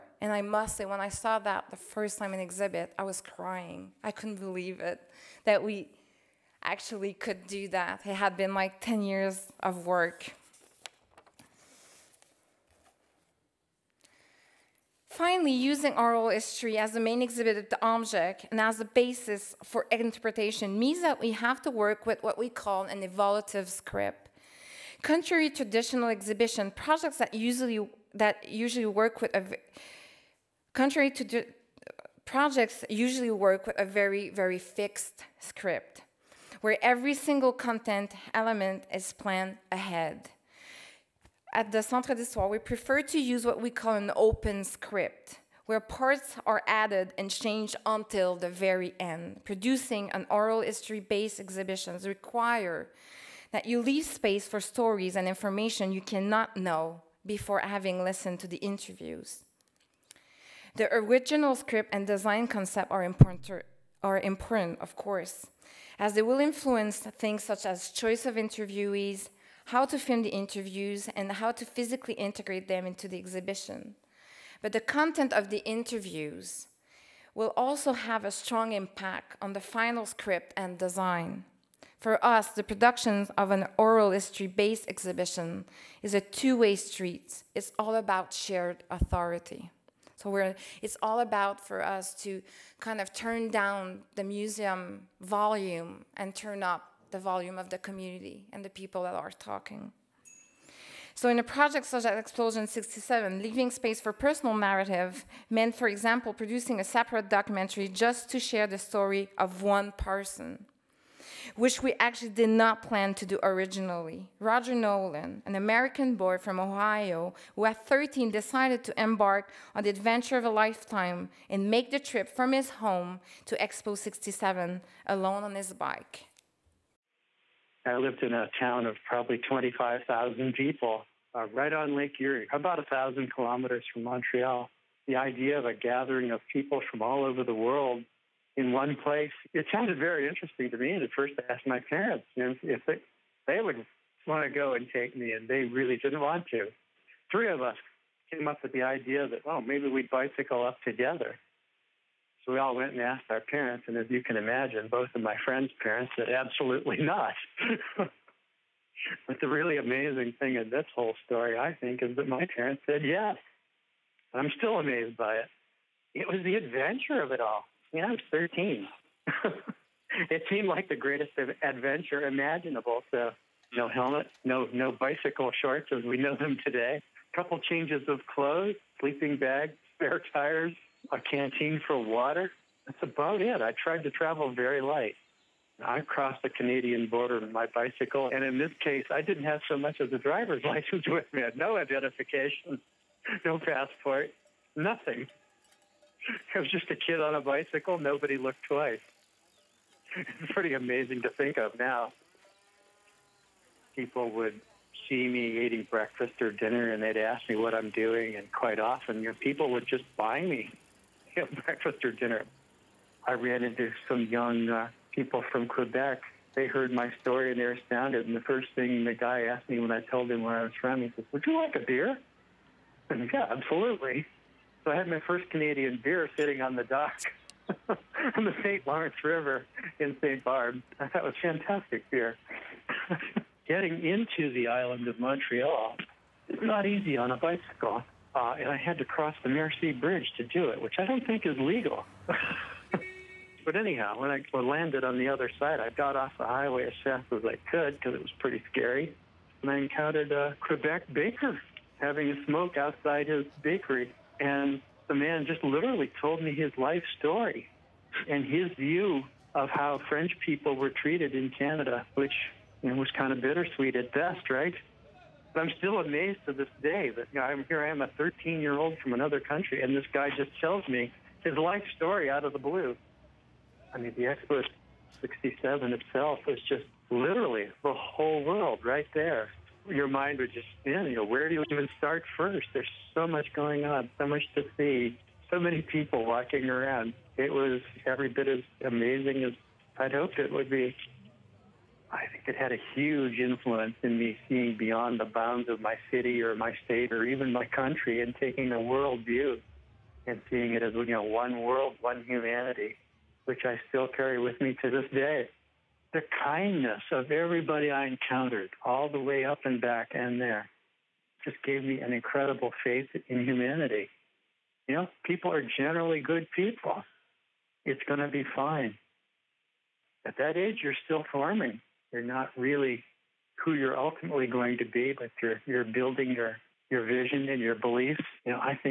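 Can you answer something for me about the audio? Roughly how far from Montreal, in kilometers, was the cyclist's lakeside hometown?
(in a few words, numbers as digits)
1000.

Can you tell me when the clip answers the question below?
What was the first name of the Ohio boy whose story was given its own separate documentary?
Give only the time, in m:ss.
1:54.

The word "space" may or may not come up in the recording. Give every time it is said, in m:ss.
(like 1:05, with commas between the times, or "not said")
0:54, 1:43.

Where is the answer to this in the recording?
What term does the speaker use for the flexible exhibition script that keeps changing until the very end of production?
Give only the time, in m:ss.
0:23.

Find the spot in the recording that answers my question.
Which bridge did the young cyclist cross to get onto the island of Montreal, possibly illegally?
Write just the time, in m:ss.
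3:59.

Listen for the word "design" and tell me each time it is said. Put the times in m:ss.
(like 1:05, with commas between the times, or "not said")
1:02, 1:20.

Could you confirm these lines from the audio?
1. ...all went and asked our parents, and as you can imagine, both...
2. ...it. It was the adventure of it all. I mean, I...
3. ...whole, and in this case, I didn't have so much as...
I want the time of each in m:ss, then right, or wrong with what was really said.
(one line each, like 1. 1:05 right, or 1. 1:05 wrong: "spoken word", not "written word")
1. 2:32 right
2. 2:45 right
3. 3:07 wrong: "bicycle", not "whole".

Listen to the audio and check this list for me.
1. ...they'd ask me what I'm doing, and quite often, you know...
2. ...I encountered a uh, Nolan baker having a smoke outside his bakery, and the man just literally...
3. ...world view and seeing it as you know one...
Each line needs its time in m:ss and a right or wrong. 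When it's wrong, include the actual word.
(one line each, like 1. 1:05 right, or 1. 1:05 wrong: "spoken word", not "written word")
1. 3:27 right
2. 4:09 wrong: "Quebec", not "Nolan"
3. 4:58 right.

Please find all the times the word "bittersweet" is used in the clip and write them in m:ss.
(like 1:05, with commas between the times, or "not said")
4:23.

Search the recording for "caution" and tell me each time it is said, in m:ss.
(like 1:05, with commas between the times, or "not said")
not said.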